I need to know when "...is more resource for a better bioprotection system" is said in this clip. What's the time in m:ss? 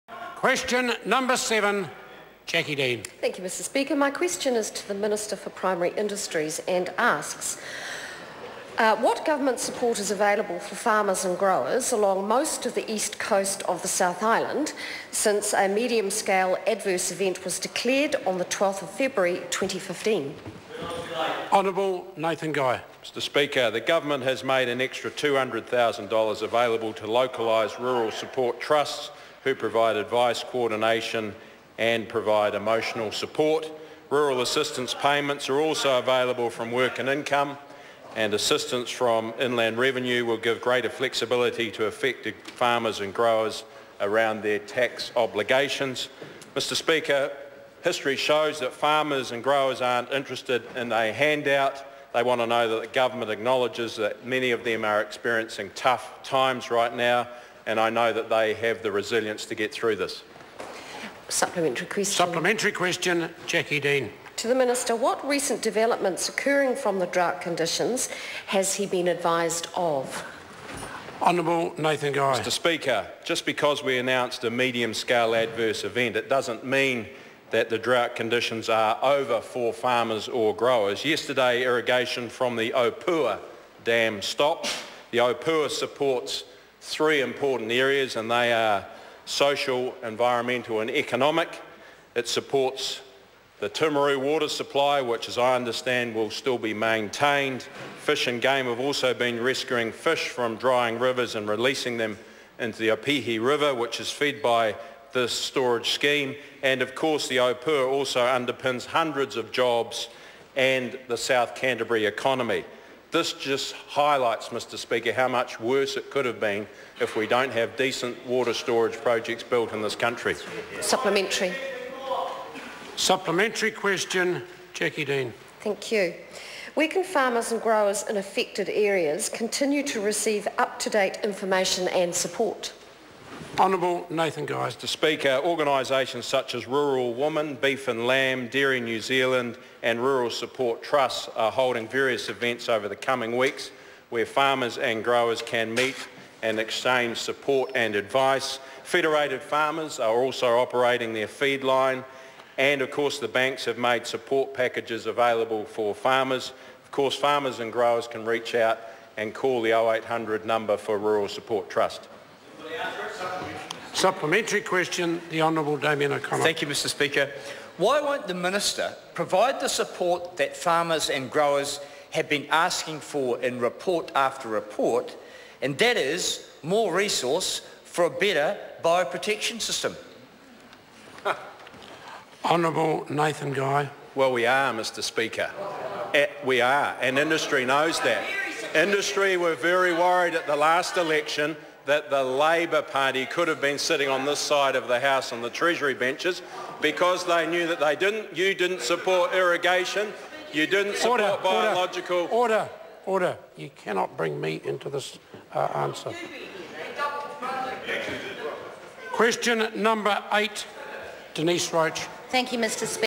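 2:55.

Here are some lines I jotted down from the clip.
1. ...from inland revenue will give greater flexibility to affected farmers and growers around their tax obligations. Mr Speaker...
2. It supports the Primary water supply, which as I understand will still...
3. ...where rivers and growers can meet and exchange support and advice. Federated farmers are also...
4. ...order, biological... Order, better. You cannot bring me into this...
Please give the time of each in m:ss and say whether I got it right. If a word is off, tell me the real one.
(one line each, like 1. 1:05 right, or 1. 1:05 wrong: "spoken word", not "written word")
1. 0:38 right
2. 1:32 wrong: "Timaru", not "Primary"
3. 2:24 wrong: "farmers", not "rivers"
4. 3:21 wrong: "order", not "better".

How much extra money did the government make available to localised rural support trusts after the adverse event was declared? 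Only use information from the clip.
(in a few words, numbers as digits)
$200,000.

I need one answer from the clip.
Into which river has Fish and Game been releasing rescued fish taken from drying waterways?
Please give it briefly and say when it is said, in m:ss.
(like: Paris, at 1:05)
Opihi River, at 1:42.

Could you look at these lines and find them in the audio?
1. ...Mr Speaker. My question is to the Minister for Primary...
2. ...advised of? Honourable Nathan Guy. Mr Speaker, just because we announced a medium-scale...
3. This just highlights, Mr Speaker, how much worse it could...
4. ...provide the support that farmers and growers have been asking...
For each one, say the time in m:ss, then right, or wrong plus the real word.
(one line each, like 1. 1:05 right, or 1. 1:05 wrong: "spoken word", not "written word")
1. 0:03 right
2. 1:09 right
3. 1:53 right
4. 2:49 right.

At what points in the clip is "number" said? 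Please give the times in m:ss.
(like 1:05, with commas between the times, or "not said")
0:01, 2:40, 3:29.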